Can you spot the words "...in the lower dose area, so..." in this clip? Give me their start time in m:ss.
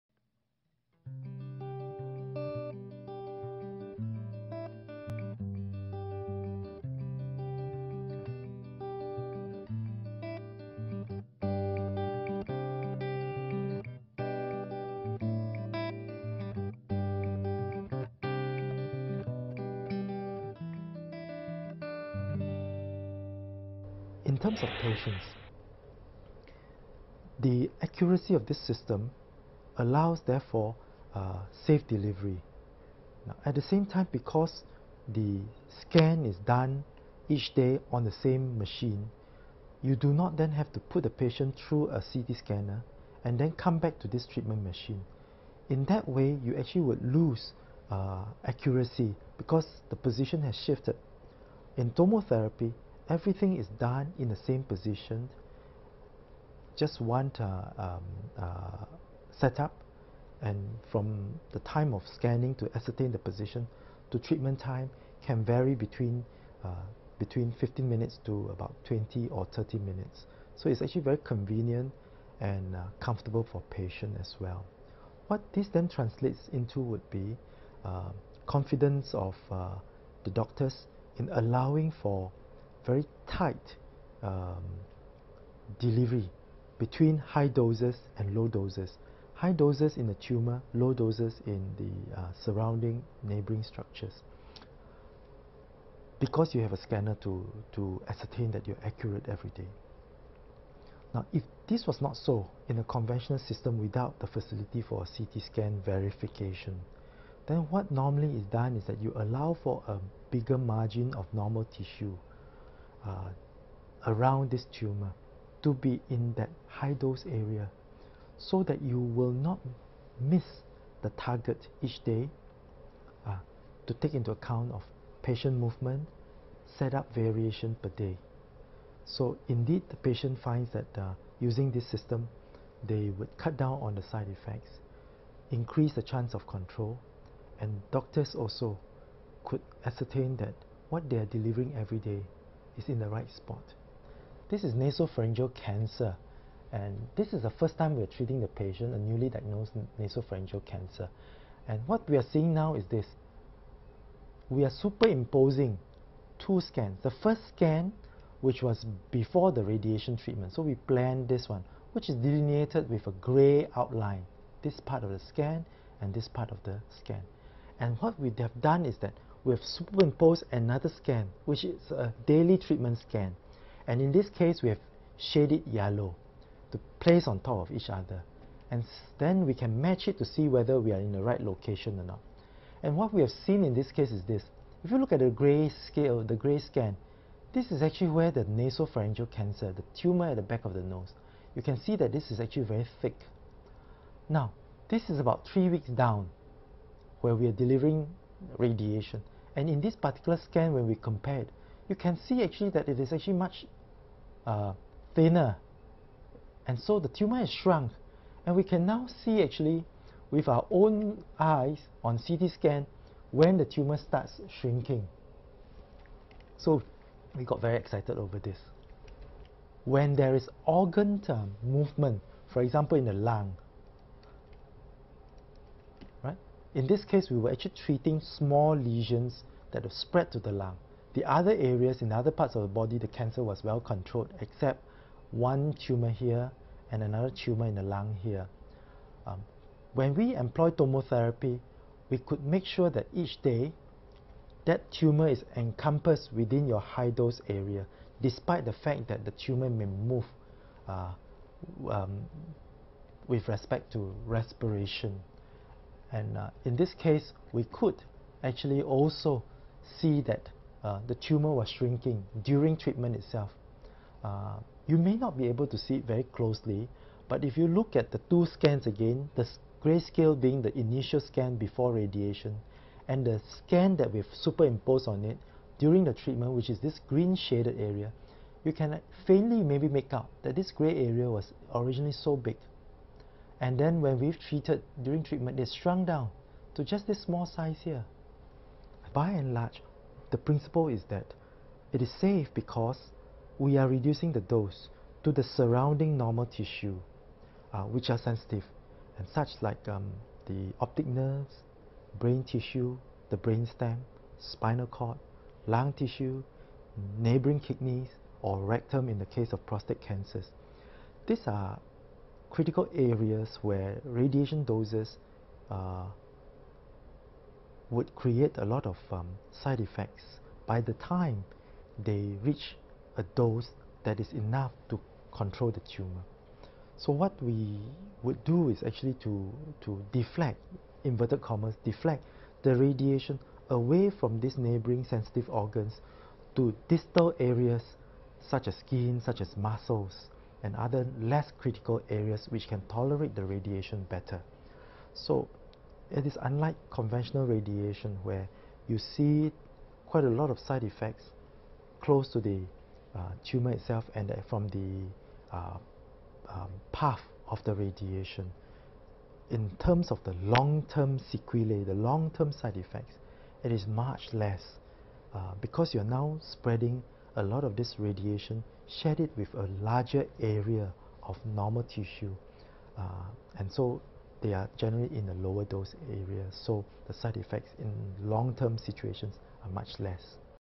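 6:15.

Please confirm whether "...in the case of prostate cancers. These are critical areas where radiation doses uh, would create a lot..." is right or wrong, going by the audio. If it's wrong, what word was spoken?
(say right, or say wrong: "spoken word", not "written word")
right.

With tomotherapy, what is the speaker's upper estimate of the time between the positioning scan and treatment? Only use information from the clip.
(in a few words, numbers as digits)
30 minutes.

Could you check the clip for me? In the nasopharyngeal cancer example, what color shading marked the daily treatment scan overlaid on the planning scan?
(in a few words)
yellow.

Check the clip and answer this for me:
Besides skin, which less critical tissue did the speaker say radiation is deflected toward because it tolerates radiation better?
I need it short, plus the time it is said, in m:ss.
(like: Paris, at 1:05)
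muscles, at 5:39.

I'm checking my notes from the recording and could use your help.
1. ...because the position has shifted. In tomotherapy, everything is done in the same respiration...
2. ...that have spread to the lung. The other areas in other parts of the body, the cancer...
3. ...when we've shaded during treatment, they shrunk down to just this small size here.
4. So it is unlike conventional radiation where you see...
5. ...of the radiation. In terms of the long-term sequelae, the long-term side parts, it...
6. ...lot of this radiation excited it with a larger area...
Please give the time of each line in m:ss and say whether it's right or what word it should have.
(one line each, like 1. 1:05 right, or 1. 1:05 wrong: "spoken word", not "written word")
1. 0:49 wrong: "position", not "respiration"
2. 3:49 right
3. 4:44 wrong: "treated", not "shaded"
4. 5:45 right
5. 5:57 wrong: "effects", not "parts"
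6. 6:07 wrong: "shared", not "excited".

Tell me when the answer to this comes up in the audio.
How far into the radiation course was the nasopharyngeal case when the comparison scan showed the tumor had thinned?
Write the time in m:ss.
3:15.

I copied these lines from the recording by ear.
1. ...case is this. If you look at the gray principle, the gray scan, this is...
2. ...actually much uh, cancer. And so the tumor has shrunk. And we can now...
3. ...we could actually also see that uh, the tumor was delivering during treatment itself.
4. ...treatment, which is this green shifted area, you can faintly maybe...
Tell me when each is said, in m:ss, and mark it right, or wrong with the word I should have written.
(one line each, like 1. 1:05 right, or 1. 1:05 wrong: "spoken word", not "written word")
1. 3:03 wrong: "scale", not "principle"
2. 3:23 wrong: "thinner", not "cancer"
3. 4:17 wrong: "shrinking", not "delivering"
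4. 4:36 wrong: "shaded", not "shifted".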